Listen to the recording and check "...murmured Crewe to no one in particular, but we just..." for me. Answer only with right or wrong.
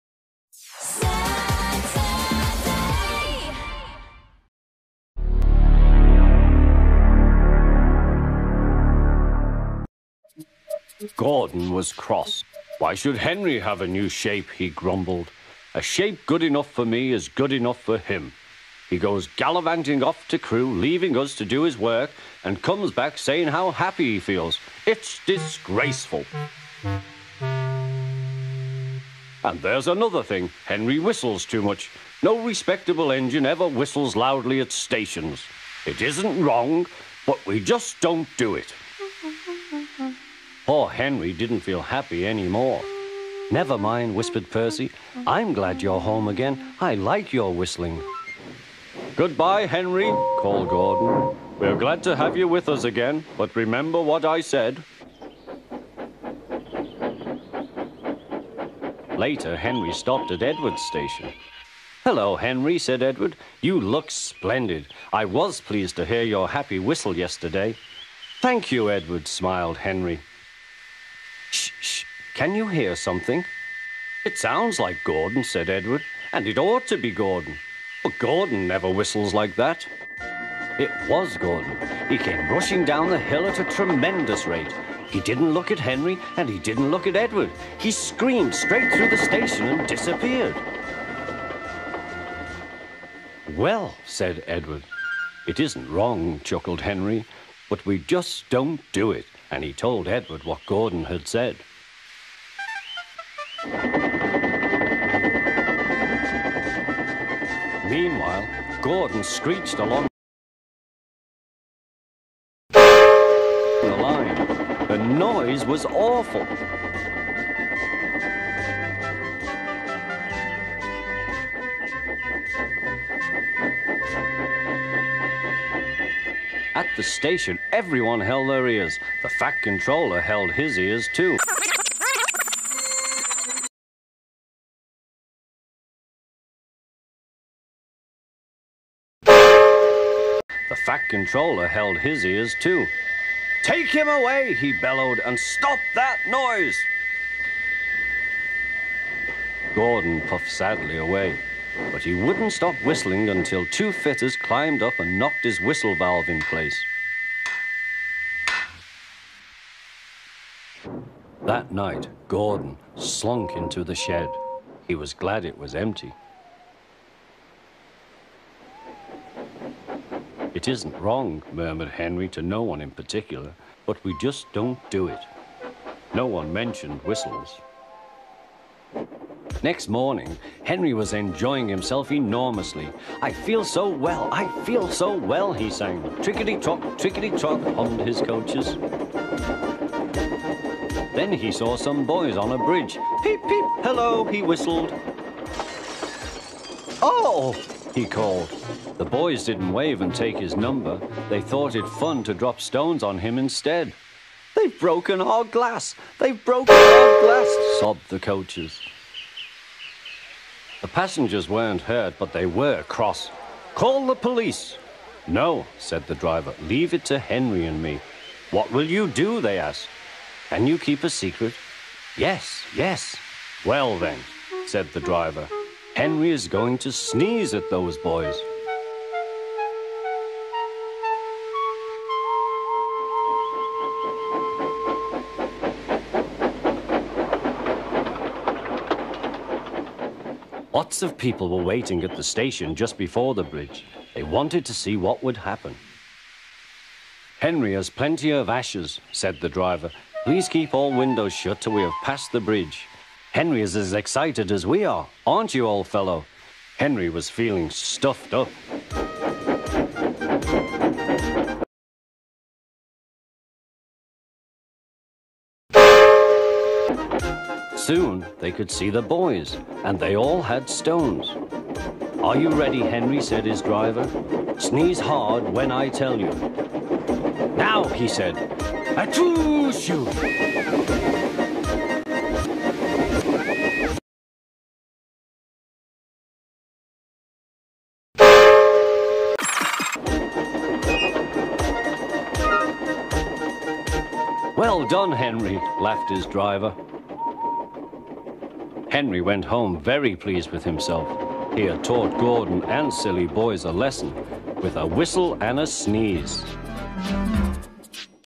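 wrong.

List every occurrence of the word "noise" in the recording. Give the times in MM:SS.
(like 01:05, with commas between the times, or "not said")
01:54, 02:26.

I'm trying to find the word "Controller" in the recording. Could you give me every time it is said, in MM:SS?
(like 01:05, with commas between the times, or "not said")
02:09, 02:21.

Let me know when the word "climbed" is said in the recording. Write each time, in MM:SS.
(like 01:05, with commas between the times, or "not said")
02:34.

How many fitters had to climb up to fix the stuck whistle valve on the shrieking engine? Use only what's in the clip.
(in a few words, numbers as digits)
2.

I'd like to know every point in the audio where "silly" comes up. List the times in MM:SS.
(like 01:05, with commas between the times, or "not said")
05:02.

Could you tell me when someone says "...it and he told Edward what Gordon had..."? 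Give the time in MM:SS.
01:39.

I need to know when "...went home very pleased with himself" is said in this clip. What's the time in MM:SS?
04:59.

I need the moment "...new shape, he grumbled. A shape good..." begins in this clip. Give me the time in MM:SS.
00:13.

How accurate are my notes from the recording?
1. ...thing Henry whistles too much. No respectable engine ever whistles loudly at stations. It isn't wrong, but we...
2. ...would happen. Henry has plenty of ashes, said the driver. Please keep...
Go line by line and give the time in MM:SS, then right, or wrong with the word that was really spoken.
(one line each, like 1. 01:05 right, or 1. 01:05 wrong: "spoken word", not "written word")
1. 00:30 right
2. 04:05 right.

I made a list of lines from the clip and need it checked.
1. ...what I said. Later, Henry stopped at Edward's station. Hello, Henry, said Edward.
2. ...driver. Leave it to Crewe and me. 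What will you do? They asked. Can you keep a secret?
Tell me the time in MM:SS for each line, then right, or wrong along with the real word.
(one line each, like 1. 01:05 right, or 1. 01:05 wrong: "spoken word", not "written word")
1. 00:54 right
2. 03:36 wrong: "Henry", not "Crewe".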